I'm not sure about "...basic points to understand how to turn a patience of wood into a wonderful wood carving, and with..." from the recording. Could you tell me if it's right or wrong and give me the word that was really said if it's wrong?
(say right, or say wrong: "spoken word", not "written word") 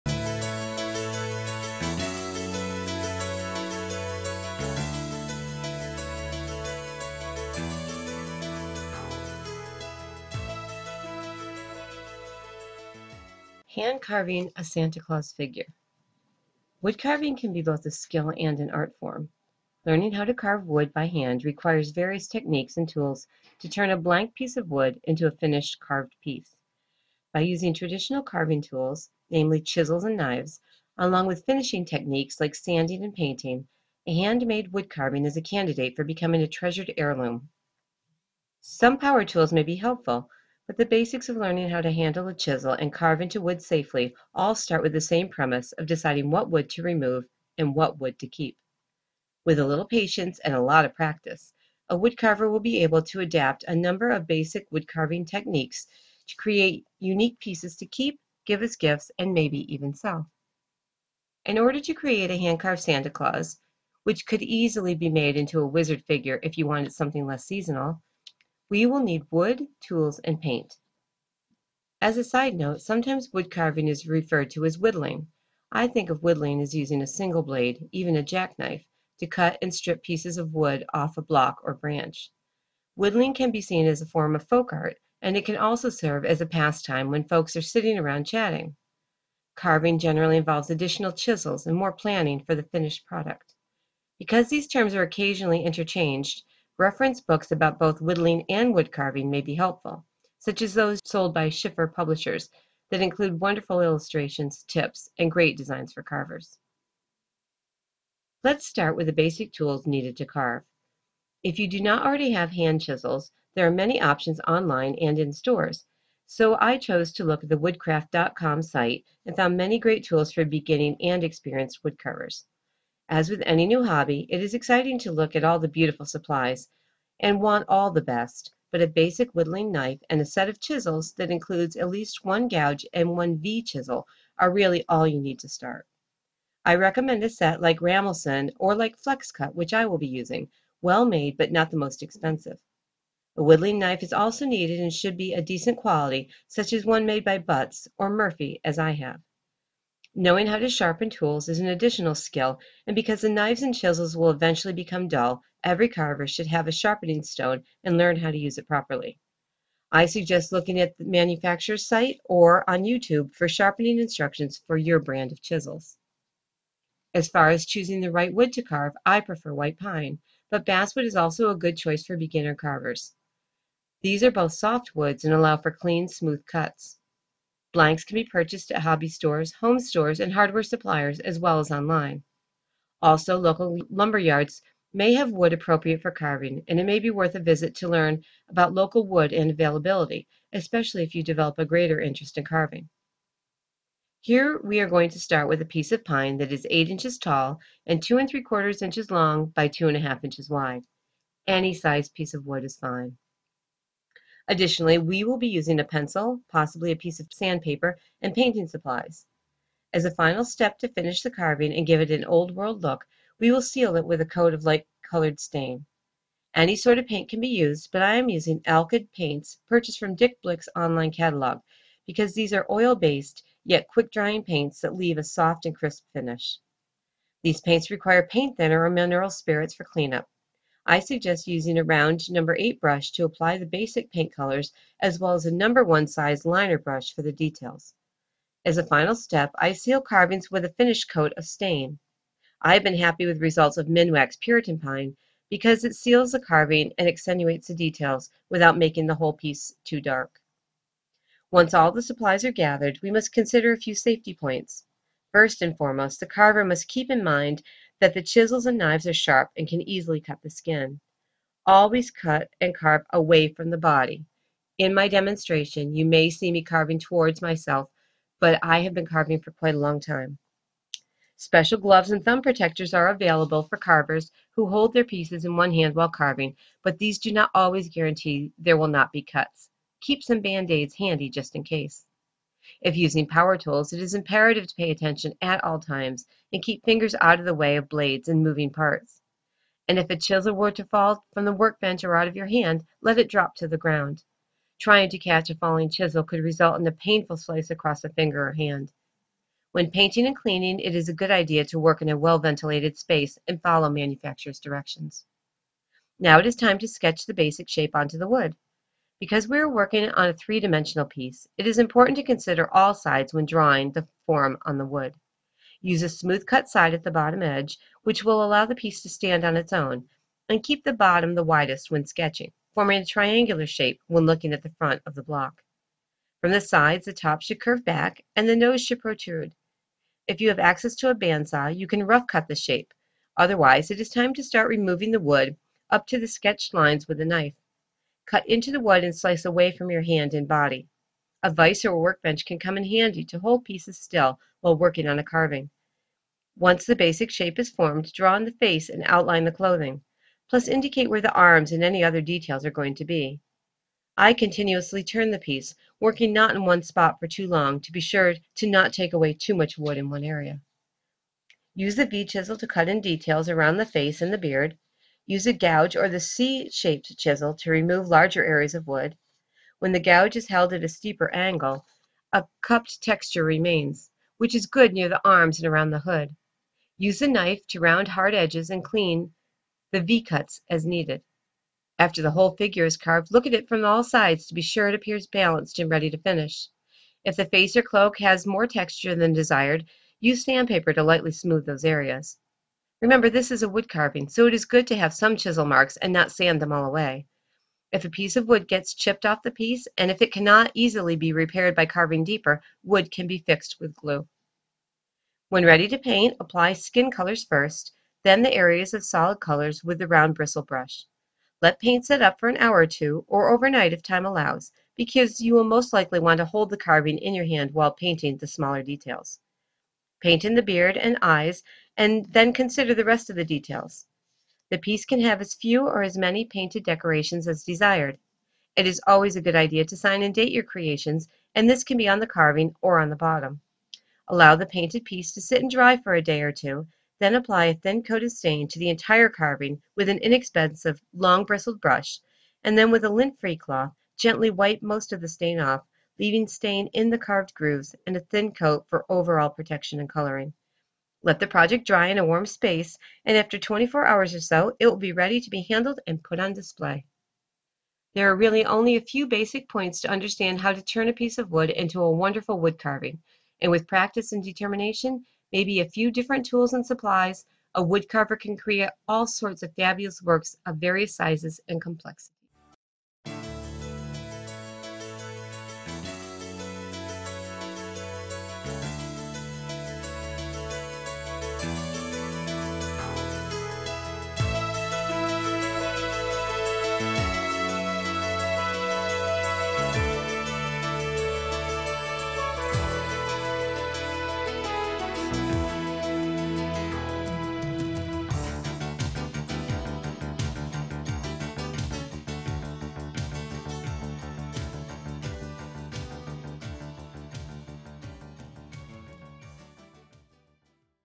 wrong: "piece", not "patience".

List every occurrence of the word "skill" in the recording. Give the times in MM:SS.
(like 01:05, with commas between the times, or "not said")
00:17, 02:32.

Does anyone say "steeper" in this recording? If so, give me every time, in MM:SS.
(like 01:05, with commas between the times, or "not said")
06:10.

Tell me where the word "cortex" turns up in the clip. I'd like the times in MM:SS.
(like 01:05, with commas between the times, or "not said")
not said.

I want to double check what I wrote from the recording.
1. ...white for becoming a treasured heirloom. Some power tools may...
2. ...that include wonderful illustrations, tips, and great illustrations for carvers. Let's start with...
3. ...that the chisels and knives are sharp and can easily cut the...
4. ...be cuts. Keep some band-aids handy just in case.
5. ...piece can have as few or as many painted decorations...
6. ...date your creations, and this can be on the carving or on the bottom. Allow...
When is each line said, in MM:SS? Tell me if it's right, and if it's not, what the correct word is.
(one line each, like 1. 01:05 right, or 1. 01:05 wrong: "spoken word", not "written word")
1. 00:35 wrong: "candidate", not "white"
2. 01:42 wrong: "designs", not "illustrations"
3. 04:18 right
4. 04:39 right
5. 07:04 right
6. 07:10 right.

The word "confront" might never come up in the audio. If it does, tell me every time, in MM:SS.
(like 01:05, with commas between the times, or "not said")
not said.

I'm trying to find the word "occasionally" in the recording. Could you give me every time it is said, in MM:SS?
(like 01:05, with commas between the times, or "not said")
01:35.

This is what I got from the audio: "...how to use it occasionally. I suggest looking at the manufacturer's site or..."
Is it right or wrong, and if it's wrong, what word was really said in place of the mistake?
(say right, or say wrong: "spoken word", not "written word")
wrong: "properly", not "occasionally".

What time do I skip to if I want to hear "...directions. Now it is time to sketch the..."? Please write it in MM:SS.
05:04.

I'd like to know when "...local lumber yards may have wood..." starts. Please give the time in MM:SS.
03:03.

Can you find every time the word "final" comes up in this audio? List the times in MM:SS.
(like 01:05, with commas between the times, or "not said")
03:30, 03:58.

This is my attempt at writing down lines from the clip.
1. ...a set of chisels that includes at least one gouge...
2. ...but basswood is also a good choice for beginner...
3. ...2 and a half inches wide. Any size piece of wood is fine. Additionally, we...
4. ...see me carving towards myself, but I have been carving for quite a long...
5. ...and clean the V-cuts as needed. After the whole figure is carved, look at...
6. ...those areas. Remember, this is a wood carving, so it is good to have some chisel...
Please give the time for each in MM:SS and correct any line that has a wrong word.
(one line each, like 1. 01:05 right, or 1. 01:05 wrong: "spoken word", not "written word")
1. 02:10 right
2. 02:50 right
3. 03:19 right
4. 04:26 right
5. 06:18 right
6. 06:31 right.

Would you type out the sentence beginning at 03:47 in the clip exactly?
These paints require paint thinner or mineral spirits for cleanup.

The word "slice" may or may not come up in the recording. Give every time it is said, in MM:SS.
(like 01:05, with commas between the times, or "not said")
04:57, 05:39.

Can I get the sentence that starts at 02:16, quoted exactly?
I recommend a set like Ramelson or like FlexCut, which I will be using, well made but not the most expensive.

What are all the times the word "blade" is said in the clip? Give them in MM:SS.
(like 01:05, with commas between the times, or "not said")
01:17, 04:47.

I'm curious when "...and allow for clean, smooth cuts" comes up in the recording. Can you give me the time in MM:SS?
02:55.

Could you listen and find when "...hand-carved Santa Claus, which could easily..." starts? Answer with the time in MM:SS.
01:02.